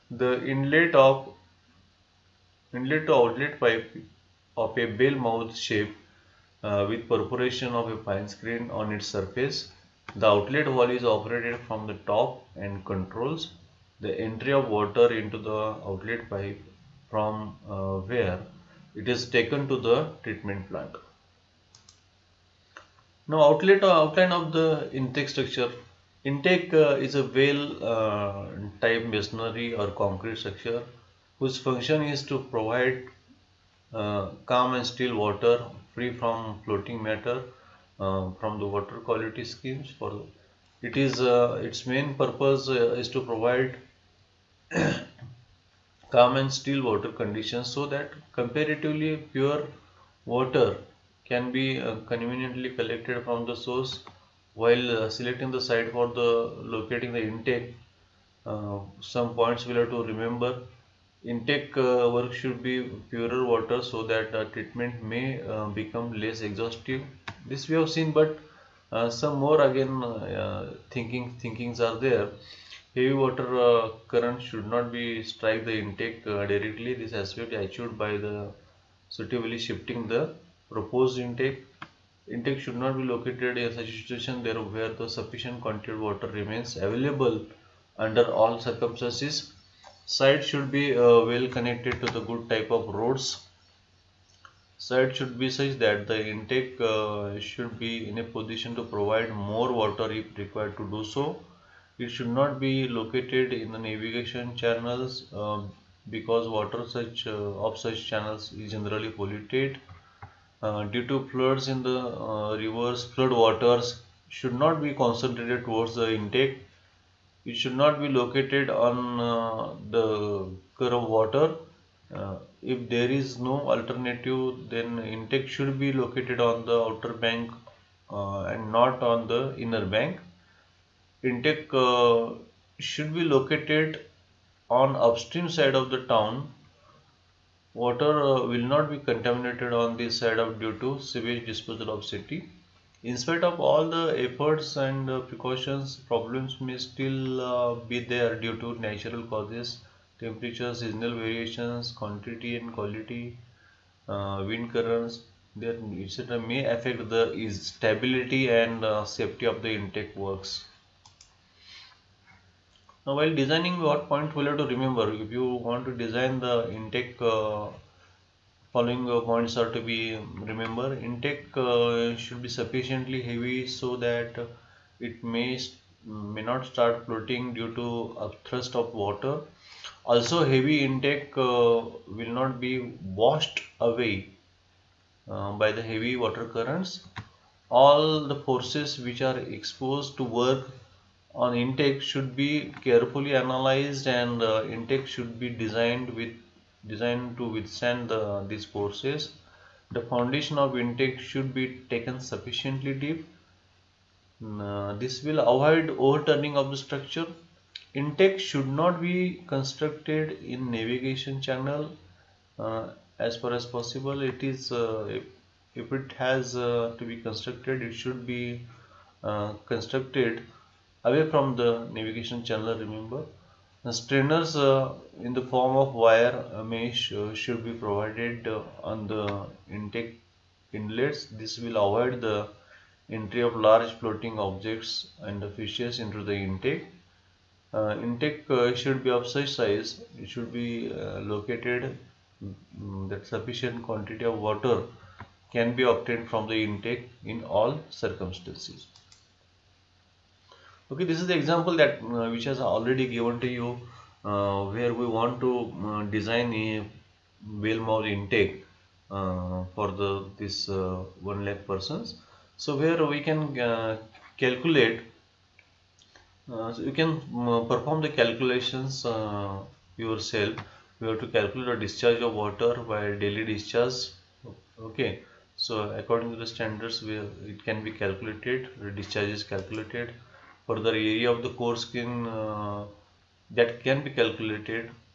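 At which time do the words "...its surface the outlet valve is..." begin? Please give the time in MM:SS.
00:08.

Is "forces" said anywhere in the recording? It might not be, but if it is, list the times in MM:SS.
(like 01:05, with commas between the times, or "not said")
03:08, 03:18.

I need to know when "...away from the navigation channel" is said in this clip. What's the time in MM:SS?
03:41.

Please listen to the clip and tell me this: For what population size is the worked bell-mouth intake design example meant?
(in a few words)
one lakh persons.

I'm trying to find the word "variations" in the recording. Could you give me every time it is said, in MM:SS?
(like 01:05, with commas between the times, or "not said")
02:31.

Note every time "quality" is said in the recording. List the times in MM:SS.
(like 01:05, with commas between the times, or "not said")
00:39, 02:32.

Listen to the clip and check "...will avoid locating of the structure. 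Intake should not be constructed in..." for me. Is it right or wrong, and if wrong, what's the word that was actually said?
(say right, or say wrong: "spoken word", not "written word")
wrong: "overturning", not "locating".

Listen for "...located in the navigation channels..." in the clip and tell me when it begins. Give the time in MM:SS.
01:42.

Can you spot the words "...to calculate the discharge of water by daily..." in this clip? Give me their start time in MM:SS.
04:31.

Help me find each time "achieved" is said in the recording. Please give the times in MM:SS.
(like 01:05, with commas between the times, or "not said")
01:17.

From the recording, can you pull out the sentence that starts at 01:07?
This we have seen but uh, some more again uh, thinking thinkings are there.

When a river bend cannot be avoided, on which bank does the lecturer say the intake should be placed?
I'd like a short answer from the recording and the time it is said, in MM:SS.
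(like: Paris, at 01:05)
outer bank, at 02:06.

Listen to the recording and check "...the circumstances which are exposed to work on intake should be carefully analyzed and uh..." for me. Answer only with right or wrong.
wrong.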